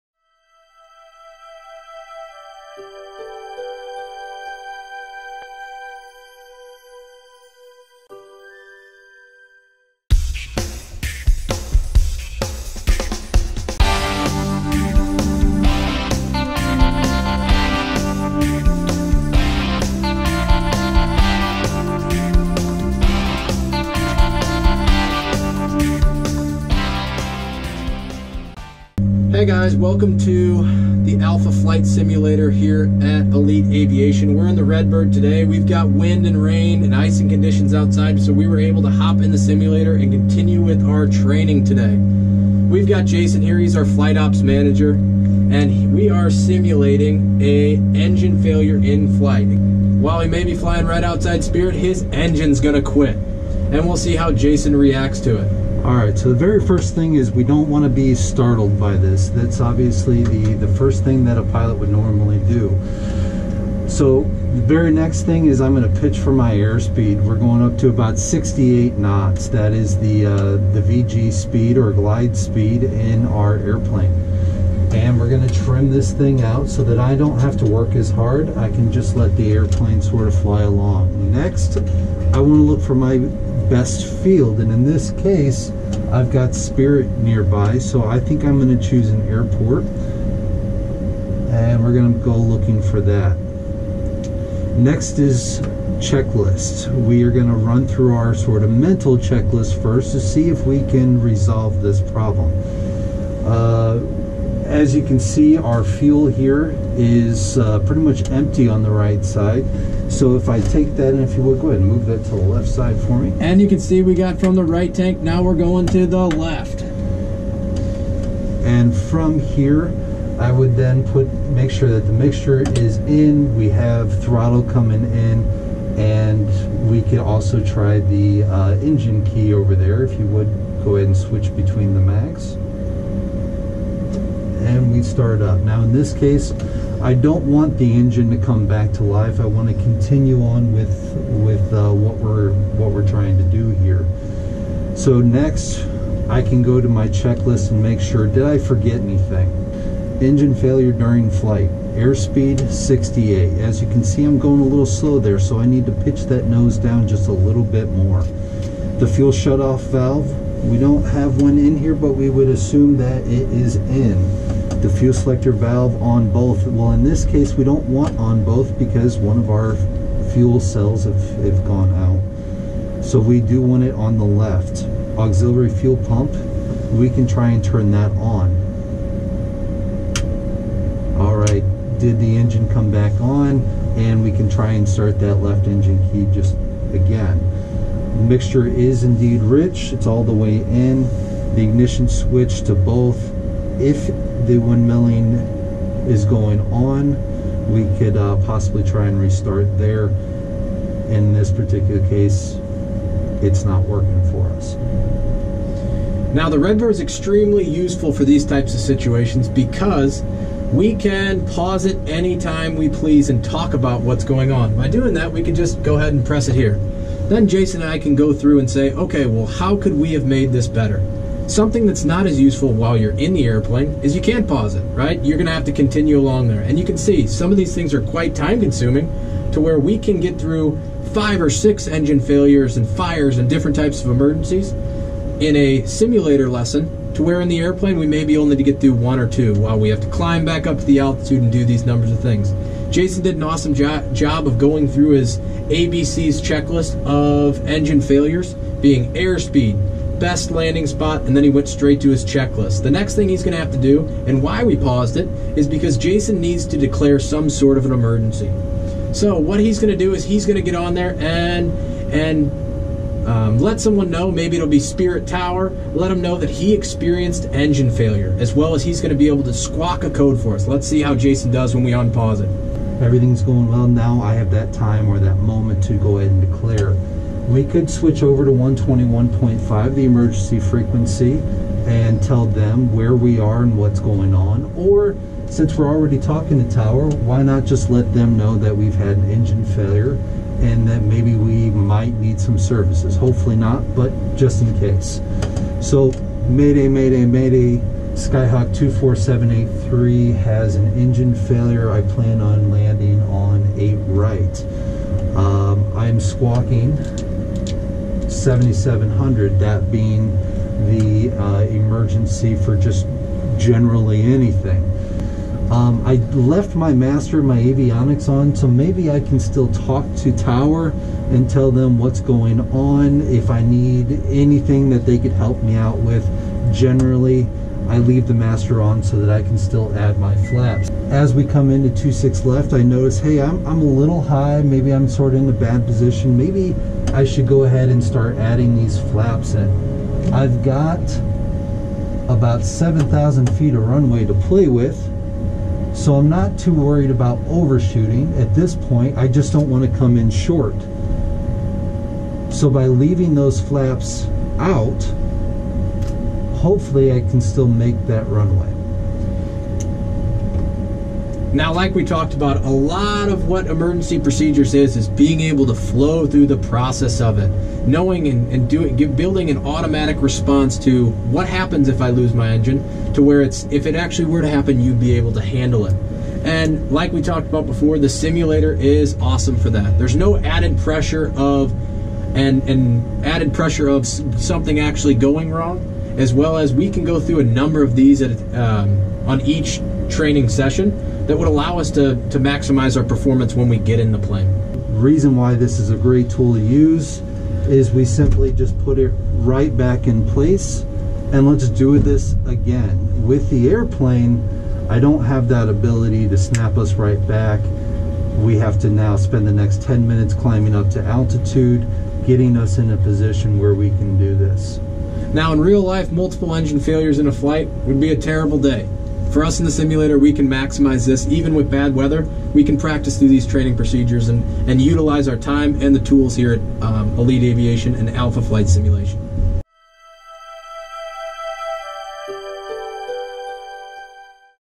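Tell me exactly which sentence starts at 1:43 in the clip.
Uh, as you can see, our fuel here is uh, pretty much empty on the right side.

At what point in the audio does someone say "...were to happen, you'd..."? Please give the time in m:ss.
6:14.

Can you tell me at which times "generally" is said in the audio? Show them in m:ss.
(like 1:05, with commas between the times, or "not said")
5:13, 5:26.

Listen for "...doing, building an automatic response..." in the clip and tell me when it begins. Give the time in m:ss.
6:08.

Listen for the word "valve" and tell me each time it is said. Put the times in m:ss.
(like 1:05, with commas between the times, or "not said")
2:39, 2:45.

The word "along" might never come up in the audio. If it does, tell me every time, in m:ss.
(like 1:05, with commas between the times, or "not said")
1:20, 3:46.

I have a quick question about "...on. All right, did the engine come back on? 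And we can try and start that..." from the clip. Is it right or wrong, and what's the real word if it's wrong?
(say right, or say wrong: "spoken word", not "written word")
right.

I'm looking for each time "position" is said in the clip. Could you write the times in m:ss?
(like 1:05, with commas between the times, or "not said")
5:35, 6:52.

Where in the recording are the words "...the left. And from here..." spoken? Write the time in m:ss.
1:56.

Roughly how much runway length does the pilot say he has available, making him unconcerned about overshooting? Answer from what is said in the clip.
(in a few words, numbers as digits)
7,000 feet.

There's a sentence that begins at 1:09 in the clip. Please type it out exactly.
That is the, uh, the VG speed or glide speed in our airplane.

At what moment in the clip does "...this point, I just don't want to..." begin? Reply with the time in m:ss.
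5:48.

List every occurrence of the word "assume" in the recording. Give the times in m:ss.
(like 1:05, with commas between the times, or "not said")
2:42.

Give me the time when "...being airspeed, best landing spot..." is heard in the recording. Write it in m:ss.
4:08.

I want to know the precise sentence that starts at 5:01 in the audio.
I plan on landing on 8 right.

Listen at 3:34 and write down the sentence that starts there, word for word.
By doing that, we can just go ahead and press it here.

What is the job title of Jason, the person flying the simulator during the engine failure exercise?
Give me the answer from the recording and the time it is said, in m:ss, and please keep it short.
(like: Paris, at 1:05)
flight ops manager, at 0:43.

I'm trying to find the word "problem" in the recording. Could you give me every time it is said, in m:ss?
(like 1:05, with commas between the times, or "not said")
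1:42.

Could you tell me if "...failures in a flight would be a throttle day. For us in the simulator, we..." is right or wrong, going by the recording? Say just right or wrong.
wrong.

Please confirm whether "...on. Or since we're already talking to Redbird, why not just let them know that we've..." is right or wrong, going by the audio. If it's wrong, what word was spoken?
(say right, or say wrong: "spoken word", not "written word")
wrong: "Tower", not "Redbird".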